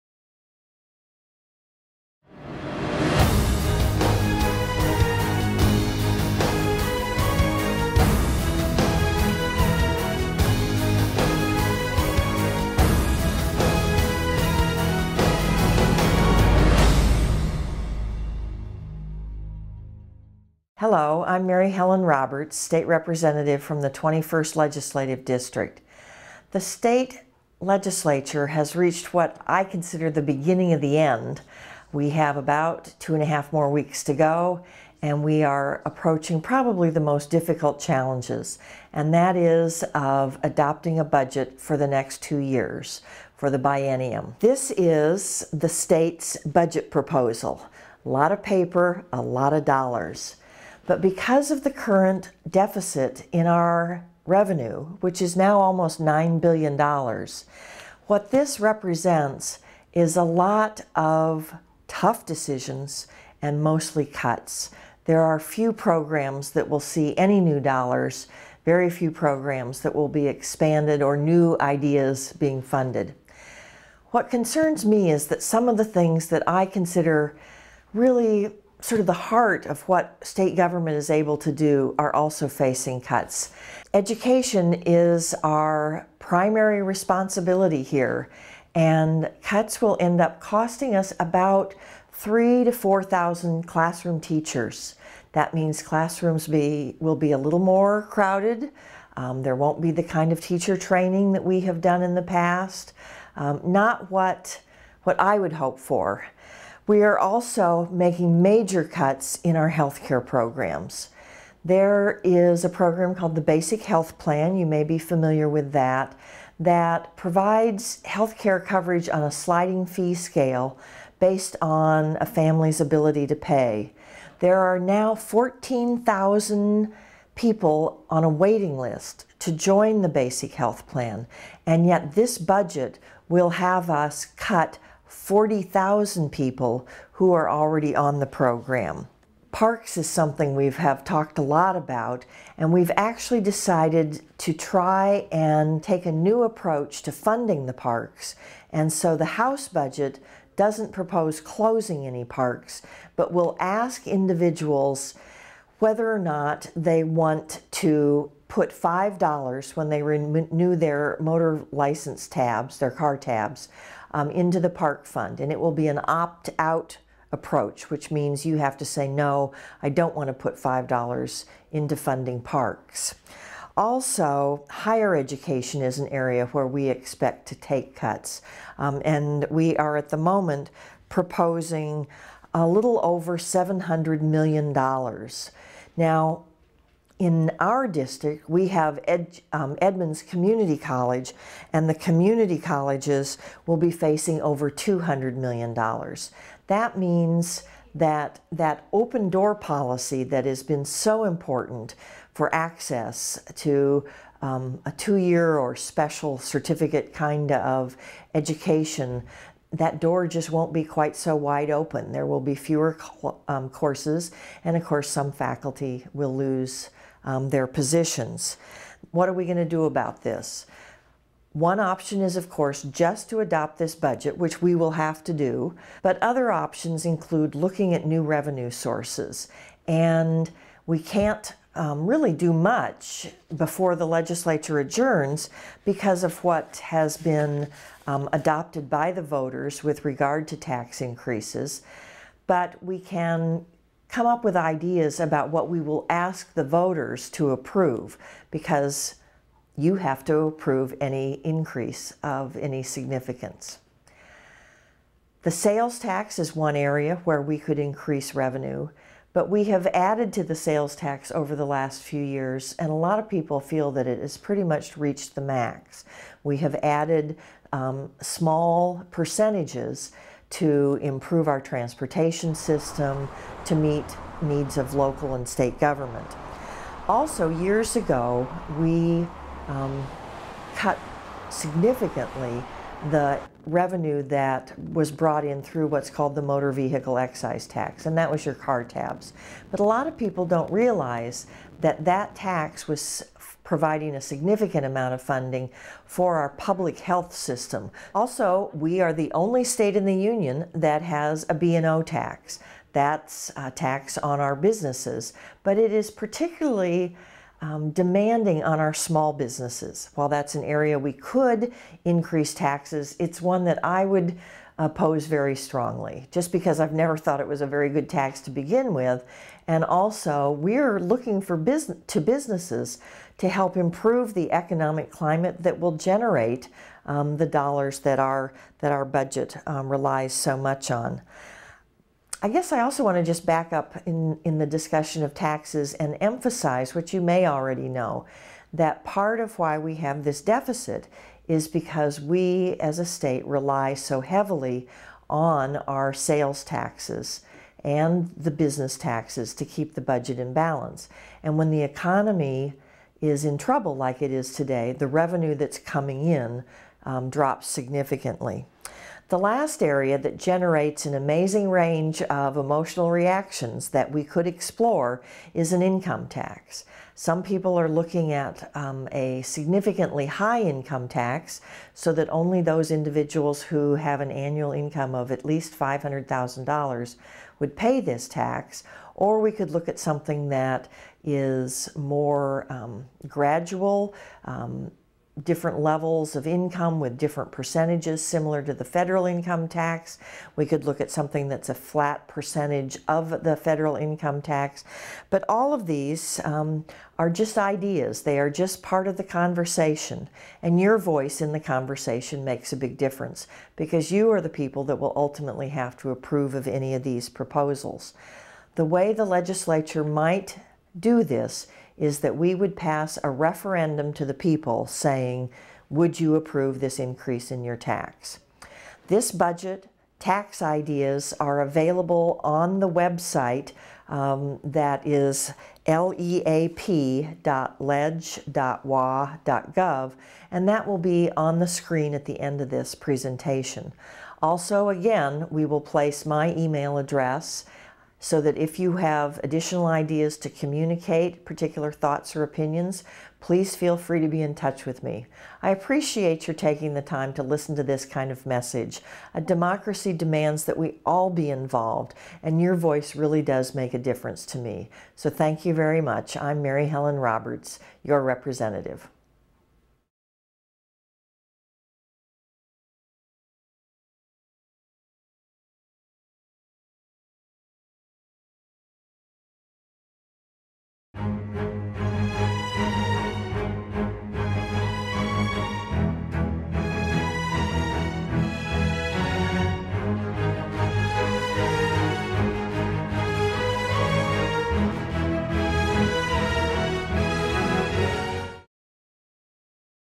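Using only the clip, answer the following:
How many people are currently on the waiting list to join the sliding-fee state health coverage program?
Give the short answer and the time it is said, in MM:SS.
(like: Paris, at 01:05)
14,000, at 02:05.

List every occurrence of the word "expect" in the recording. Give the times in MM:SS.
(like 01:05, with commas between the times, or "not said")
02:56.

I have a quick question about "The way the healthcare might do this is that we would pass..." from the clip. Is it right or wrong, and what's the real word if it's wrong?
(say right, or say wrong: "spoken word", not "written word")
wrong: "legislature", not "healthcare".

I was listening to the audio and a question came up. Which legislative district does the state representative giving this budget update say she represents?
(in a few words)
21st.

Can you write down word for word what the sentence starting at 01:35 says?
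That means classrooms be, will be a little more crowded.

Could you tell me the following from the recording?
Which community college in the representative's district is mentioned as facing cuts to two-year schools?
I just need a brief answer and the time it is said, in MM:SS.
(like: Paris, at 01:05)
Edmonds Community College, at 03:09.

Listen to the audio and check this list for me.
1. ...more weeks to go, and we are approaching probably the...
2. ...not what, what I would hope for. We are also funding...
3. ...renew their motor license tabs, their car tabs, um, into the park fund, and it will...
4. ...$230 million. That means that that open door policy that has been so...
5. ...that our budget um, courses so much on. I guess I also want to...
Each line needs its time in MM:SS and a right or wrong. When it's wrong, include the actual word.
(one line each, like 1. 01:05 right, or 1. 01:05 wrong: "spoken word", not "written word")
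1. 00:33 right
2. 01:43 wrong: "making", not "funding"
3. 02:40 right
4. 03:14 wrong: "200", not "230"
5. 05:28 wrong: "relies", not "courses".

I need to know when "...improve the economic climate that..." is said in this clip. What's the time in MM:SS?
05:23.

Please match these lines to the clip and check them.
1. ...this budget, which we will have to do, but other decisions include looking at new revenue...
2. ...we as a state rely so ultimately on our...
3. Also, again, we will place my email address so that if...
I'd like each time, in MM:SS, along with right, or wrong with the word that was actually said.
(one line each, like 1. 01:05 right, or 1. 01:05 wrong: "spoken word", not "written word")
1. 03:43 wrong: "options", not "decisions"
2. 05:42 wrong: "heavily", not "ultimately"
3. 07:14 right.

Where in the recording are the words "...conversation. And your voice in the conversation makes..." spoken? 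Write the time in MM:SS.
06:39.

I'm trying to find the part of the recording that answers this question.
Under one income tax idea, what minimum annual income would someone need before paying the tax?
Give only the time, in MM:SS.
06:15.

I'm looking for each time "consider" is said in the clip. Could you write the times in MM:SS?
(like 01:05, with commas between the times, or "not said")
00:29, 01:16.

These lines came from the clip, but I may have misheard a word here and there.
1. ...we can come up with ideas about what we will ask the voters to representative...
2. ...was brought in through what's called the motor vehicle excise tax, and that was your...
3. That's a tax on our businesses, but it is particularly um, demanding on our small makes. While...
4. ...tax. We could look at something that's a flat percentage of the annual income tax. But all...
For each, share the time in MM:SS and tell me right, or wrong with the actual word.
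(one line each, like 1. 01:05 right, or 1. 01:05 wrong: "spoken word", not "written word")
1. 04:02 wrong: "approve", not "representative"
2. 04:44 right
3. 05:02 wrong: "businesses", not "makes"
4. 06:29 wrong: "federal", not "annual".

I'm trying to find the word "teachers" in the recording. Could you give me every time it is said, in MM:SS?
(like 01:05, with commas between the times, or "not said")
01:34, 01:40.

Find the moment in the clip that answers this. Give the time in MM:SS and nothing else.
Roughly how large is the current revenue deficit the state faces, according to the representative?
00:55.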